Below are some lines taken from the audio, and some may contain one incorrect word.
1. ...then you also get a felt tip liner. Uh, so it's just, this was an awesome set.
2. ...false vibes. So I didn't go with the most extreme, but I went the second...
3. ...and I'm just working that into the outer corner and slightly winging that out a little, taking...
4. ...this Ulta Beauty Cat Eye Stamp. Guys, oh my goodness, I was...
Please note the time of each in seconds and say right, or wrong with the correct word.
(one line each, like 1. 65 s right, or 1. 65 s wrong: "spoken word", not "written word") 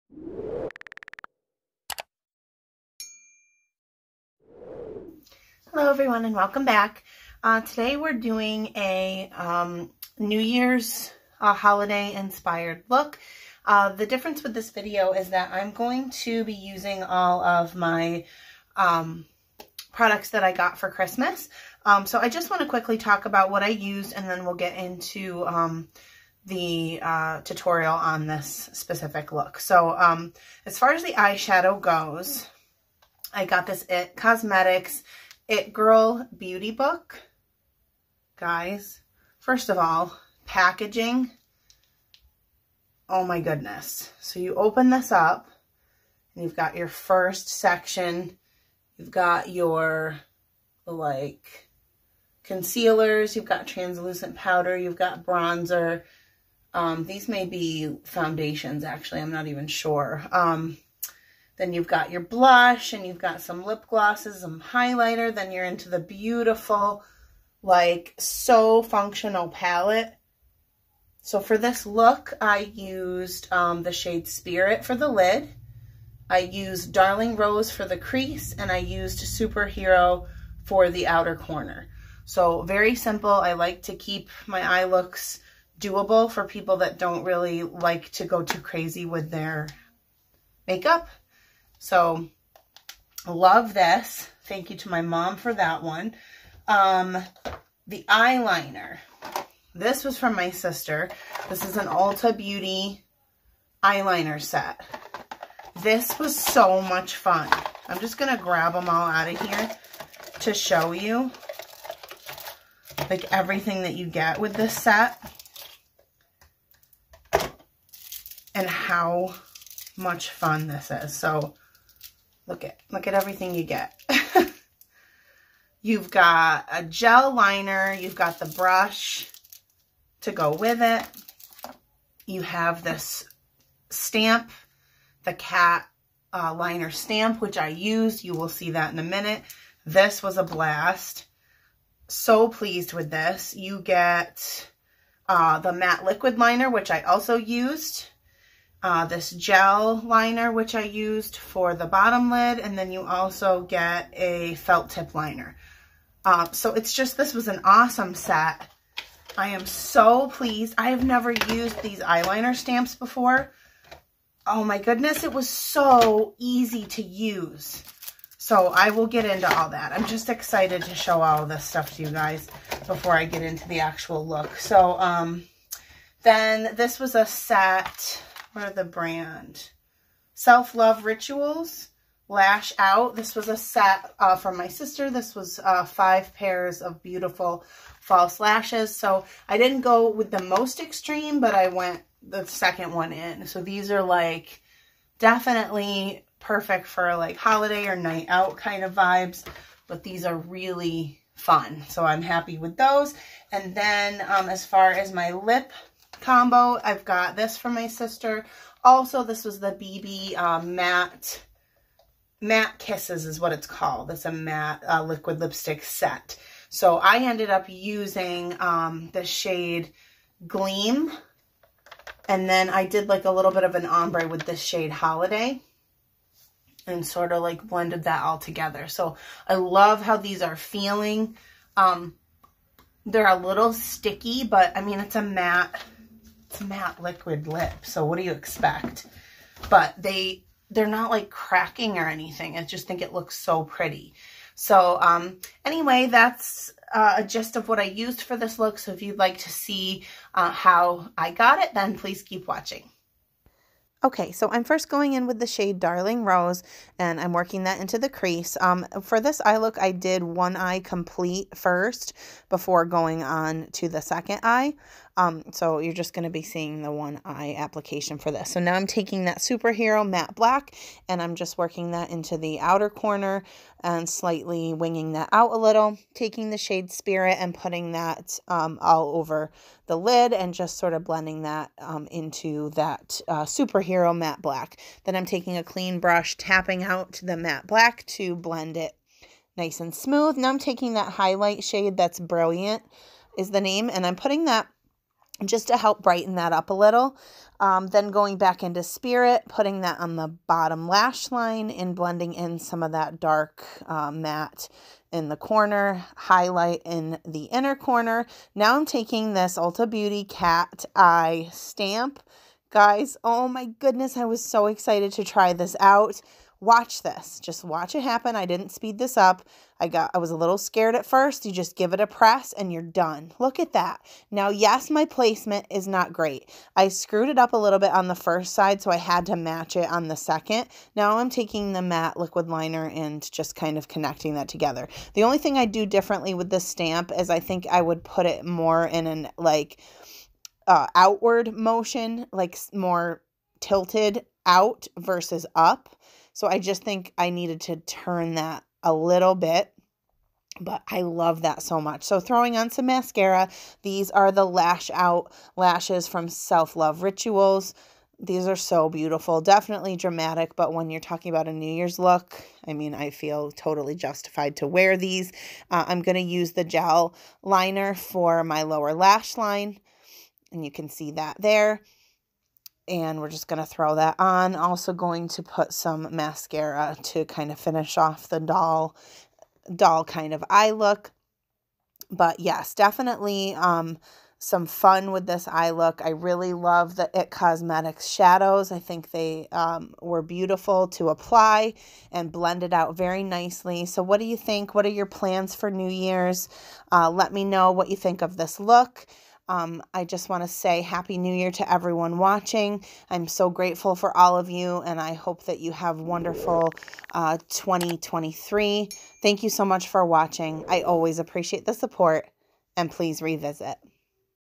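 1. 152 s right
2. 187 s wrong: "lashes", not "vibes"
3. 271 s right
4. 309 s right.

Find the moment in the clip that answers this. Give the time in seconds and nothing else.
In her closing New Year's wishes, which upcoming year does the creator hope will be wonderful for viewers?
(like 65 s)
407 s.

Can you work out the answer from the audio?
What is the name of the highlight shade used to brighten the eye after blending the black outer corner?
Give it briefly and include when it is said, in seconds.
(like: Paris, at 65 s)
Brilliant, at 292 s.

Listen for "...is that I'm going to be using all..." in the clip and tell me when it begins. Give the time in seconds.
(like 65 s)
15 s.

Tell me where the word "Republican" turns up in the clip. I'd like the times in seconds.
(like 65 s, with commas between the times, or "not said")
not said.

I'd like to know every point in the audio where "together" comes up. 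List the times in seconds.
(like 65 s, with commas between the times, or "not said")
228 s, 334 s.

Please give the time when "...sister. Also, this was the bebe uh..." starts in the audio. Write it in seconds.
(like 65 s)
207 s.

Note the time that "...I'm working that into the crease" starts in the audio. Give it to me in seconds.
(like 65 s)
257 s.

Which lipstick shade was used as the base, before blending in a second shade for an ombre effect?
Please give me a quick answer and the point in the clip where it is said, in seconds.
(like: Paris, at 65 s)
Gleam, at 220 s.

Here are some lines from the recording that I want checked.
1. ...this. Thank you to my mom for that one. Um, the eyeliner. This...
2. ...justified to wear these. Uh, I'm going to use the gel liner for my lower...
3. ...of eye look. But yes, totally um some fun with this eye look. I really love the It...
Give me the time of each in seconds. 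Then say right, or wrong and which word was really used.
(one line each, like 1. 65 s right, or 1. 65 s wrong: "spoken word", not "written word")
1. 93 s right
2. 363 s right
3. 380 s wrong: "definitely", not "totally".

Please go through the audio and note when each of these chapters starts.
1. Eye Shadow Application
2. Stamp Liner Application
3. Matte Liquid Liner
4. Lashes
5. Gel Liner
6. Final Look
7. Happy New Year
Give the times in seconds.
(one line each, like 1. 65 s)
1. 252 s
2. 308 s
3. 330 s
4. 351 s
5. 366 s
6. 381 s
7. 400 s.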